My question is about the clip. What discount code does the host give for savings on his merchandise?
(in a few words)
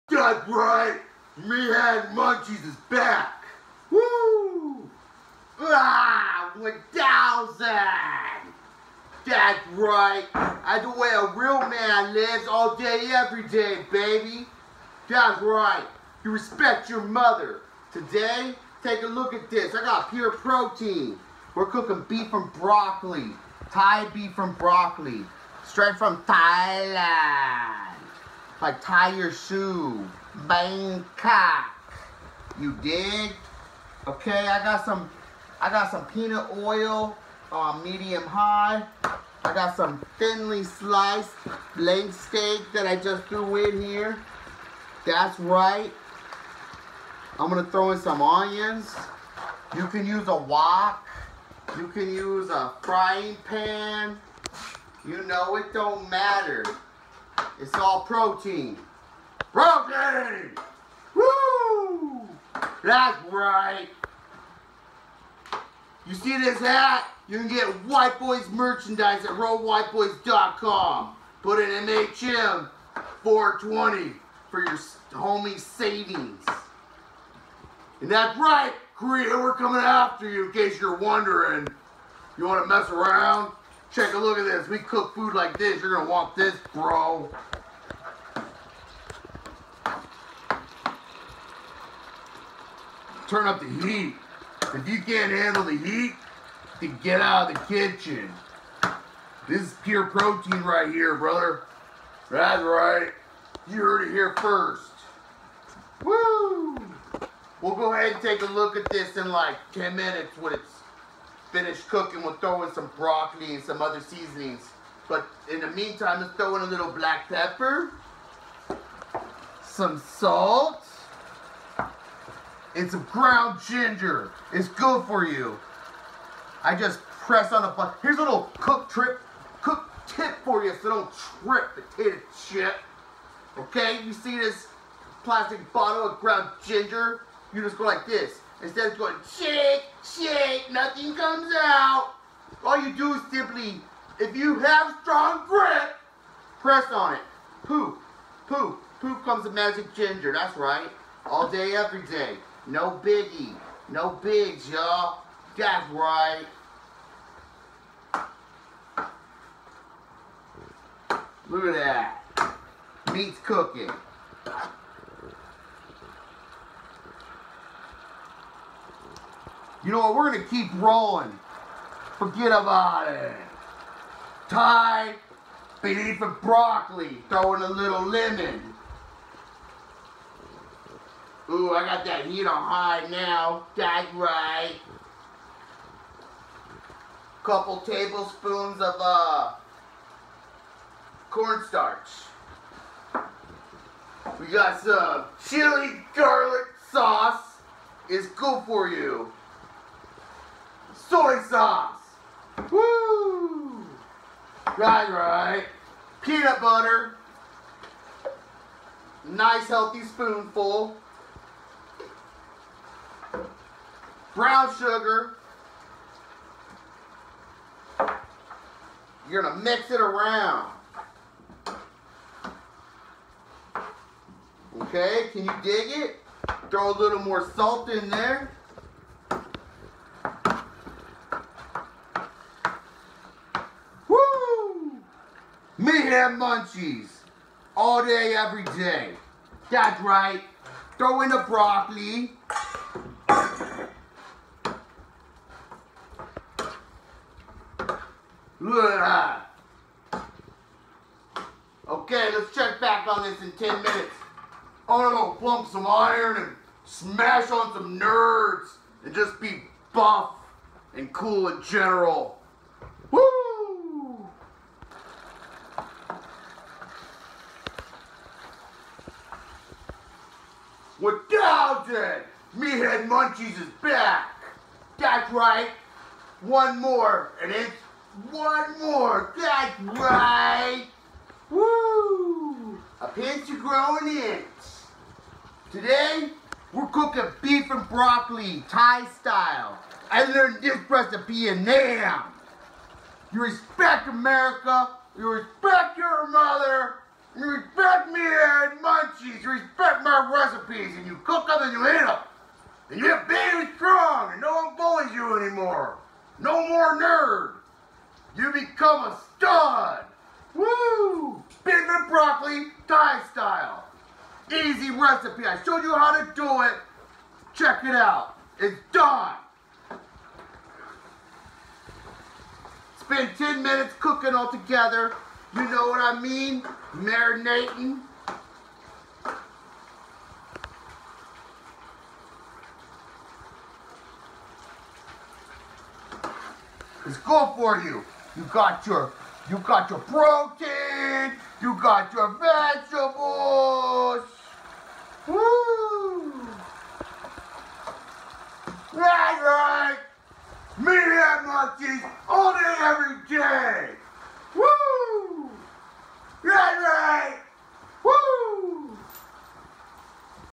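MHM 420.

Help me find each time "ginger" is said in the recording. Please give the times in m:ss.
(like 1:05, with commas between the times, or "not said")
2:03, 2:16, 2:29.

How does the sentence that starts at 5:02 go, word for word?
And you're big and strong and no one bullies you anymore.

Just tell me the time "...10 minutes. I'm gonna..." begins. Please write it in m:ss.
4:13.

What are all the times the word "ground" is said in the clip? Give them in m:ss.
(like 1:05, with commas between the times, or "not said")
2:03, 2:16.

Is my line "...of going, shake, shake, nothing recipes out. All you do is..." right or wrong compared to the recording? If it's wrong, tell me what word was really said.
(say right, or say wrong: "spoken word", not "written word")
wrong: "comes", not "recipes".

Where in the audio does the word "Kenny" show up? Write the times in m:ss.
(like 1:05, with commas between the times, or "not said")
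not said.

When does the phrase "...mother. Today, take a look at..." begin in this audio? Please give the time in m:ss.
0:17.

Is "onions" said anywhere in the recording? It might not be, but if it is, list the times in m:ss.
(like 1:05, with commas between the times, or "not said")
0:48.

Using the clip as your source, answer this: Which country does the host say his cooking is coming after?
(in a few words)
Korea.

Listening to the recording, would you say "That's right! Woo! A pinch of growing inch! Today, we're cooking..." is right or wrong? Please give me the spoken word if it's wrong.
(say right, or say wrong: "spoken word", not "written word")
right.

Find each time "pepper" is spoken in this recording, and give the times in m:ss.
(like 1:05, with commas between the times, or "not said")
1:57.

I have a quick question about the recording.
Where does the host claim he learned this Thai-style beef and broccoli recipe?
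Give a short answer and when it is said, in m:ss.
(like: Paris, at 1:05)
Nam, at 4:51.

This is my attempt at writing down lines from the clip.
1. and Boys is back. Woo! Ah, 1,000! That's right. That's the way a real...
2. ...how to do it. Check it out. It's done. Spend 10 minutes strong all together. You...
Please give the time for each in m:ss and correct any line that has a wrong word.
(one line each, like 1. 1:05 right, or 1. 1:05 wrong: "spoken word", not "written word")
1. 0:01 wrong: "Munchies", not "Boys"
2. 5:15 wrong: "cooking", not "strong".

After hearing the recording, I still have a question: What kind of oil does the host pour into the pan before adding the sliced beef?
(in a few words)
peanut oil.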